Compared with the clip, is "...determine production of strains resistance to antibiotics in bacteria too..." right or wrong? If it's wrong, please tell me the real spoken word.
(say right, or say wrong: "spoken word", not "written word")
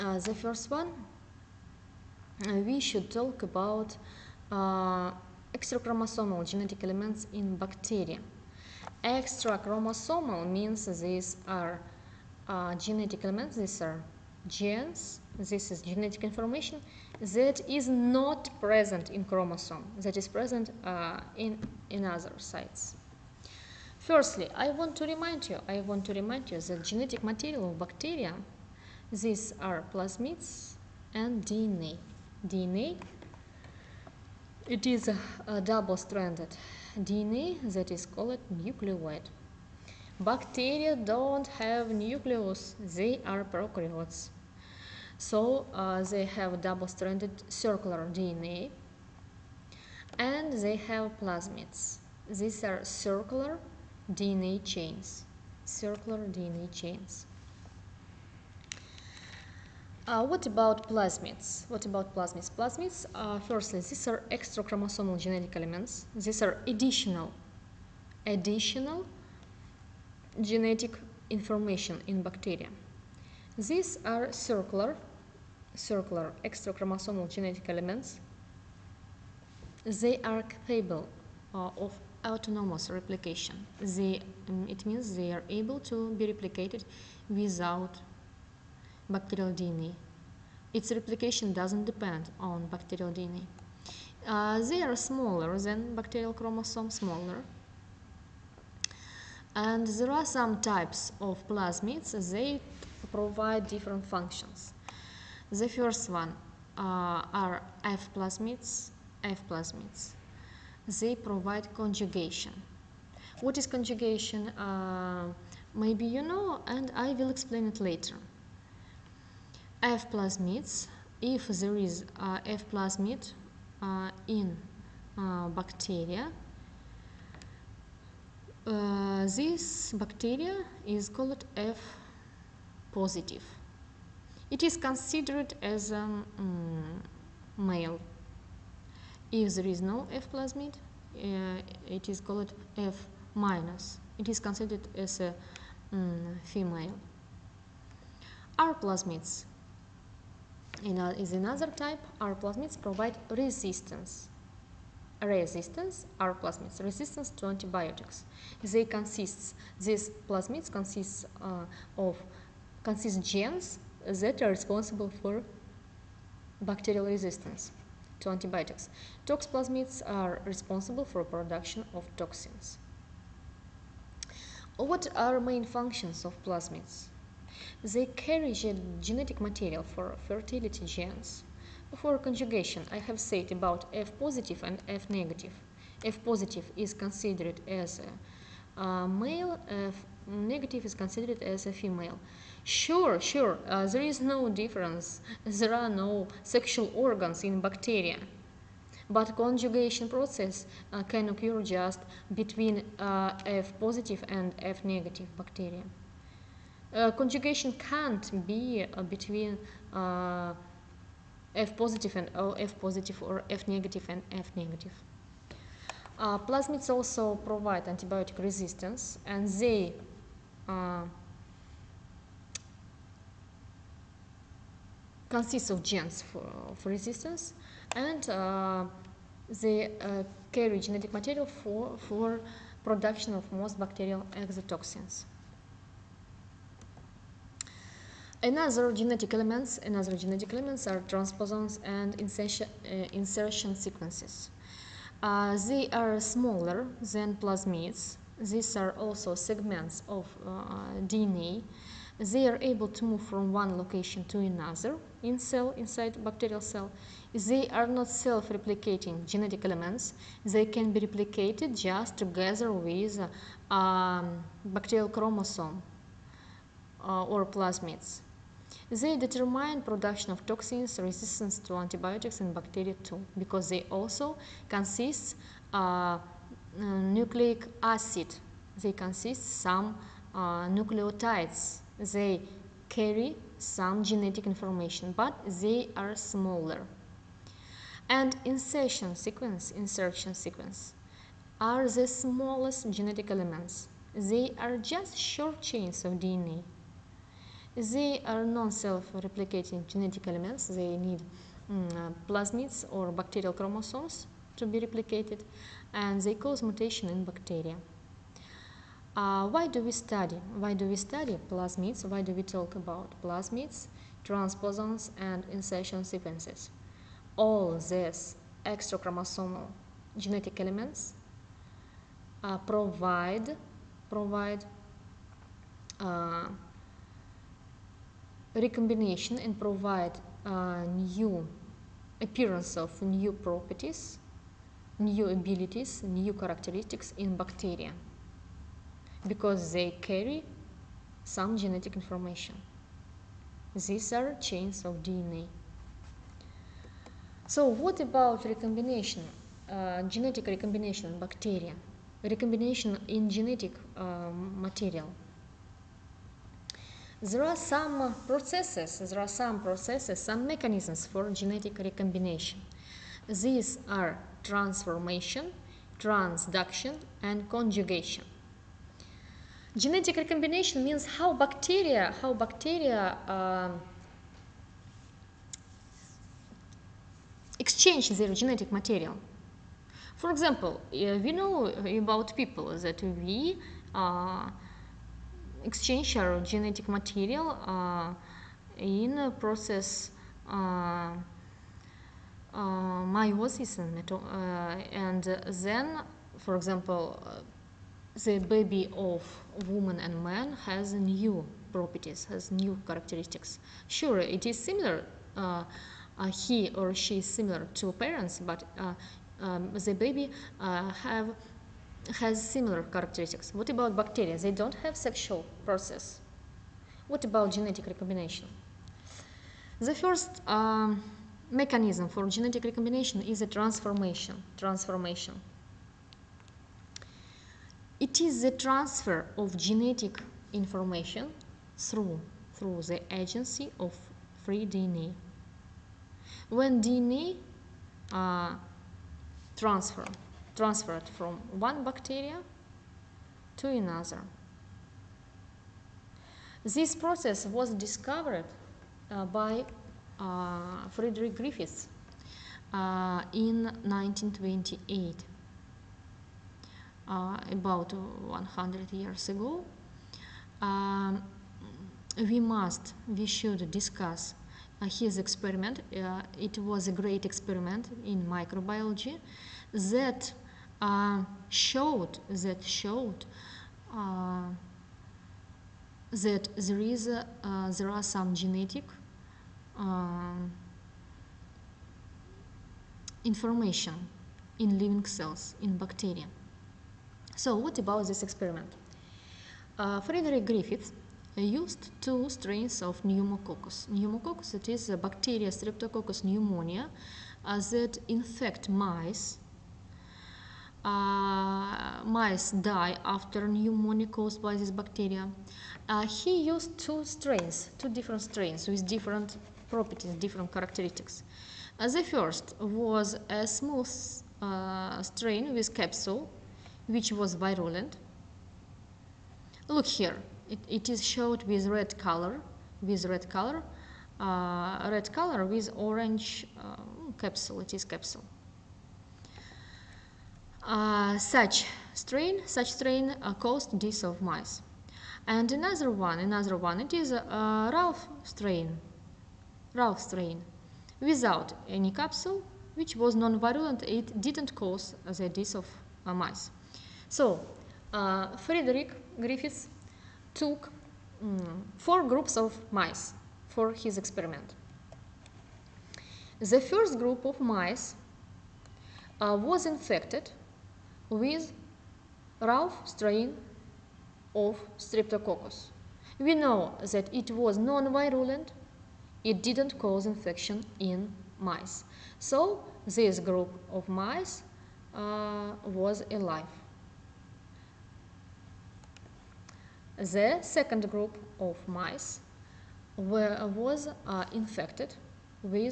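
wrong: "toxins", not "strains".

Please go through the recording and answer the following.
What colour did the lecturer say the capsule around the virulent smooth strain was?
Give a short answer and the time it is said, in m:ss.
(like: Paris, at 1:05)
Orange, at 8:45.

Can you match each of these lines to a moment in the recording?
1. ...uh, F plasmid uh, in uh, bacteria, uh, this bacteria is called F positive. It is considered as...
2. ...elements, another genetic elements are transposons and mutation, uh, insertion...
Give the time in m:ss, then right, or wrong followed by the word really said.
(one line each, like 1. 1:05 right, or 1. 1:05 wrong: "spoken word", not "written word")
1. 2:02 right
2. 3:59 wrong: "insertion", not "mutation".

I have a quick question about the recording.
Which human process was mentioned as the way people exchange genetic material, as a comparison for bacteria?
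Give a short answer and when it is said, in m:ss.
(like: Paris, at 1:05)
Meiosis, at 6:33.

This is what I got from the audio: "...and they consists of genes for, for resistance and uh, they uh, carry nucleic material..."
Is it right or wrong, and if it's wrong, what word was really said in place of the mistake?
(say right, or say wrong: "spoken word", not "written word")
wrong: "genetic", not "nucleic".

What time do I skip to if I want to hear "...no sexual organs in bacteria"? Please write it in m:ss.
3:15.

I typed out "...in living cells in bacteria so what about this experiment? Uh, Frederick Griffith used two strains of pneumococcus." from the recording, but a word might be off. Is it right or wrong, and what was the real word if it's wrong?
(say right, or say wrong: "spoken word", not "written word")
right.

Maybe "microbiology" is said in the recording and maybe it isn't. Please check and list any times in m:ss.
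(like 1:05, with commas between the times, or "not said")
7:48.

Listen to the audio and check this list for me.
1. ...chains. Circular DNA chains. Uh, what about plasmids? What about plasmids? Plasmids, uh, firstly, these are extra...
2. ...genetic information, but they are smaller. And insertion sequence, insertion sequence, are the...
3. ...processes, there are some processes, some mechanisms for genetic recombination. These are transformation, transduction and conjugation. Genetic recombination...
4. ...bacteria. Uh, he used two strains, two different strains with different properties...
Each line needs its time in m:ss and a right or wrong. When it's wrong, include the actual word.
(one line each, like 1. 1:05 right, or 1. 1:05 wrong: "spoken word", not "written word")
1. 0:54 right
2. 4:44 right
3. 5:58 right
4. 8:24 right.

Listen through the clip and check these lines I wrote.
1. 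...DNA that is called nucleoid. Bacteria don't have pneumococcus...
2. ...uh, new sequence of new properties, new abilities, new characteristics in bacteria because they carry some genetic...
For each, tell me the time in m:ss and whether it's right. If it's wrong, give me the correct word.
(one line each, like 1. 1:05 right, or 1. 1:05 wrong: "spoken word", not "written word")
1. 0:36 wrong: "nucleus", not "pneumococcus"
2. 5:30 wrong: "appearance", not "sequence".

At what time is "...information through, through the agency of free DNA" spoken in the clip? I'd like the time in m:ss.
7:10.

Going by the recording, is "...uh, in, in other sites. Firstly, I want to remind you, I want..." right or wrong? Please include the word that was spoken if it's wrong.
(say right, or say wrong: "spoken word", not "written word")
right.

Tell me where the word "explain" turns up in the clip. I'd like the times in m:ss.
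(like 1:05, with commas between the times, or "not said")
1:57.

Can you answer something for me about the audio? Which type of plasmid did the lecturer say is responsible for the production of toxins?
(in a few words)
Tox plasmids.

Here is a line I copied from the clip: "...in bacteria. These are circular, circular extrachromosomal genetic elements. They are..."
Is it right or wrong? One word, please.
right.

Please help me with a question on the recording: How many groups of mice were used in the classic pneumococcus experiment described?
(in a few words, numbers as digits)
4.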